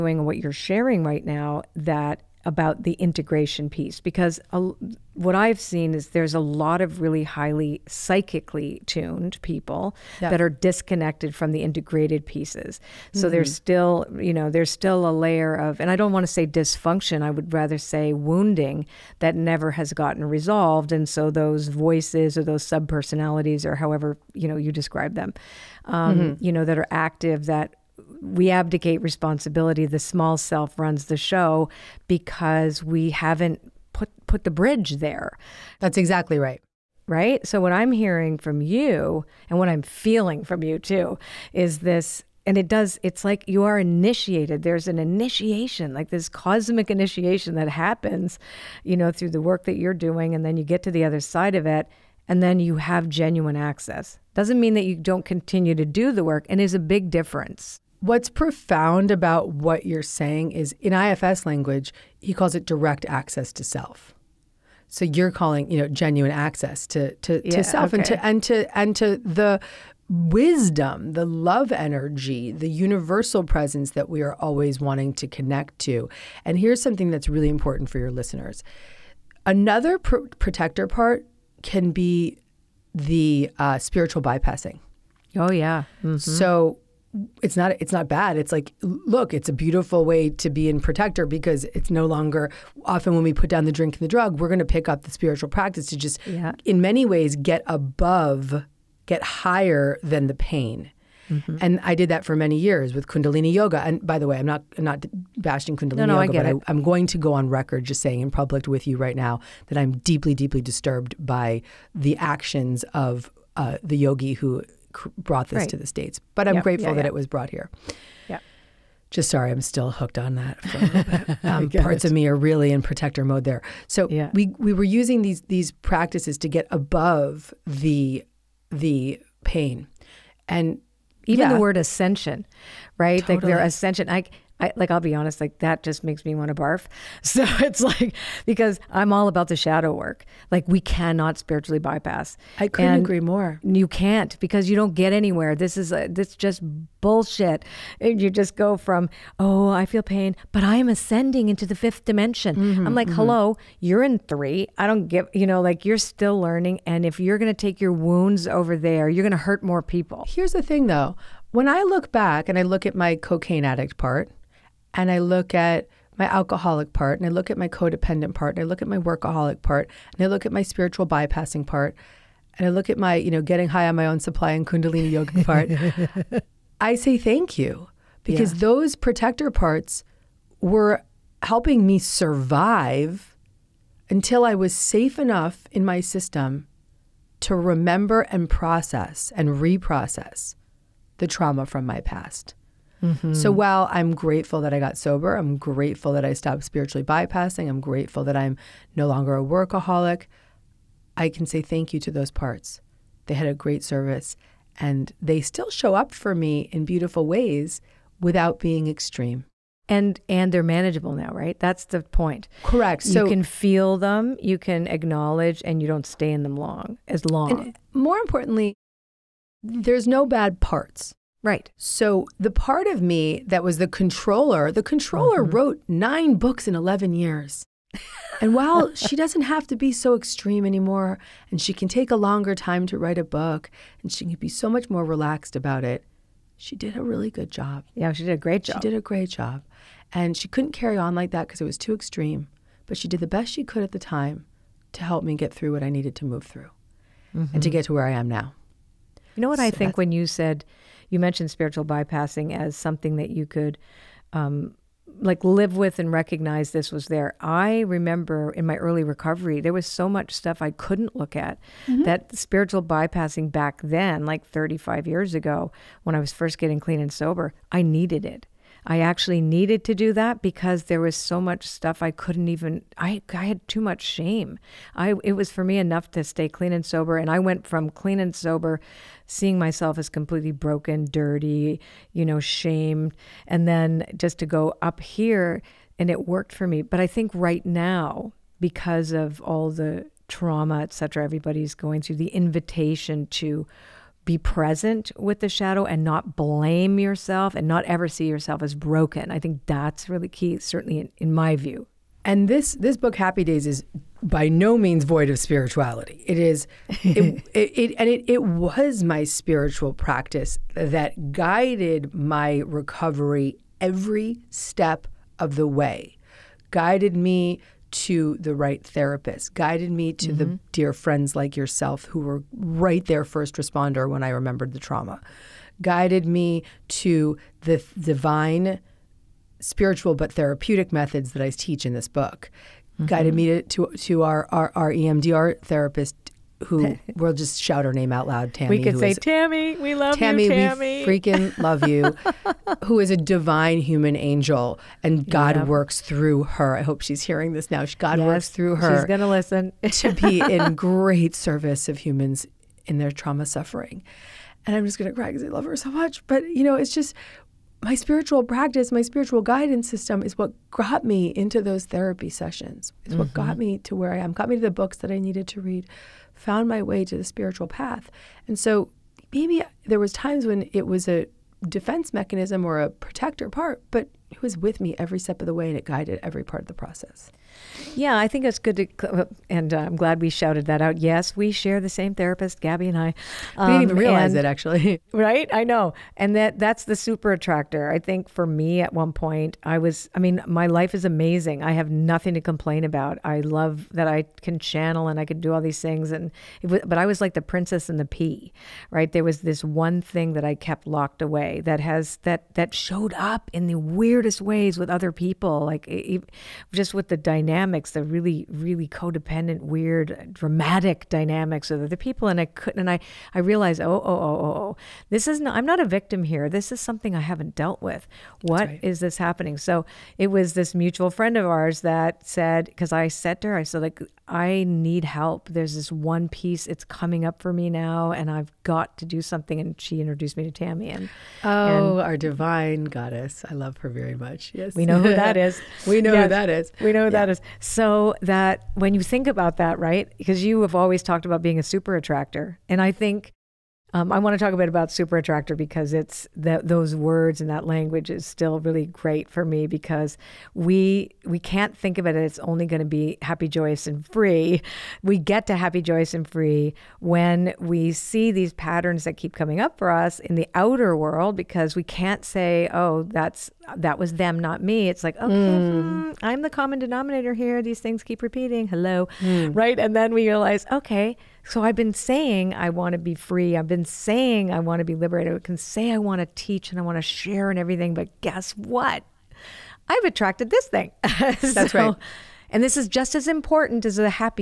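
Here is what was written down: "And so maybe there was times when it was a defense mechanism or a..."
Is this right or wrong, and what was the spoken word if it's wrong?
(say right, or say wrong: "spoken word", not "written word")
right.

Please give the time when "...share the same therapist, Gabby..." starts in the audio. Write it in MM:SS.
06:21.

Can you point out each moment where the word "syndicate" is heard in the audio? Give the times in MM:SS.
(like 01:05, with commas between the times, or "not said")
not said.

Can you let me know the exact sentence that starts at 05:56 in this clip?
But, you know, it's just my spiritual practice, my spiritual guidance system is what got me into those therapy sessions.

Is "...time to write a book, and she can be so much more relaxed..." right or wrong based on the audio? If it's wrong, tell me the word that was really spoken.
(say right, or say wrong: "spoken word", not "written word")
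right.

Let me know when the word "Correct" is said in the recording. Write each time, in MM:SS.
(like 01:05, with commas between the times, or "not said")
03:32.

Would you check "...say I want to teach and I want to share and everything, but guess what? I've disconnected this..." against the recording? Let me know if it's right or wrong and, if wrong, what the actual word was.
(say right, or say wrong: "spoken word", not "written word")
wrong: "attracted", not "disconnected".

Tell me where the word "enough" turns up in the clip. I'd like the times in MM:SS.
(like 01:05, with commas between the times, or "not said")
03:05, 04:35.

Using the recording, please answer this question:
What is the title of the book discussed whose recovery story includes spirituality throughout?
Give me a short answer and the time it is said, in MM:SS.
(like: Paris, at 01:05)
Happy Days, at 05:03.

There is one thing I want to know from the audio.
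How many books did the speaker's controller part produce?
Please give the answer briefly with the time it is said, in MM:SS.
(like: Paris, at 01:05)
9, at 03:45.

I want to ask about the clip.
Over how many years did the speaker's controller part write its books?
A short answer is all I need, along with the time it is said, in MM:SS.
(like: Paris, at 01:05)
11, at 03:46.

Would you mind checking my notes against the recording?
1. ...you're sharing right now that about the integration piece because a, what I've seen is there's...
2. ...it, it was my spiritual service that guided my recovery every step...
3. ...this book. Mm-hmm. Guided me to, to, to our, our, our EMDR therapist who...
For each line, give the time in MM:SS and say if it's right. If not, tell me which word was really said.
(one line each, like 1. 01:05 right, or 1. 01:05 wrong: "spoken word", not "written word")
1. 00:00 right
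2. 05:08 wrong: "practice", not "service"
3. 05:31 right.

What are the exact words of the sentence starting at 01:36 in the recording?
in many ways get above get higher than the pain mm -hmm.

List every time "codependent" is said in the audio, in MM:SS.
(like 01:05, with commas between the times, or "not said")
02:47, 06:48.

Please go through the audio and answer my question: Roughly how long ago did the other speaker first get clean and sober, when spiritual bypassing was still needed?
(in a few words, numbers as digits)
35 years ago.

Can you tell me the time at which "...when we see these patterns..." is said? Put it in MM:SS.
07:36.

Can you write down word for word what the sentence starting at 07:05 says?
There's this one piece, it's coming up for me now, and I've got to do something.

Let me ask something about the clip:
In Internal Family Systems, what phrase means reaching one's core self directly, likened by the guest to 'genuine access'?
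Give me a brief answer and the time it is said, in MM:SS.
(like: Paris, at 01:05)
direct access to self, at 01:02.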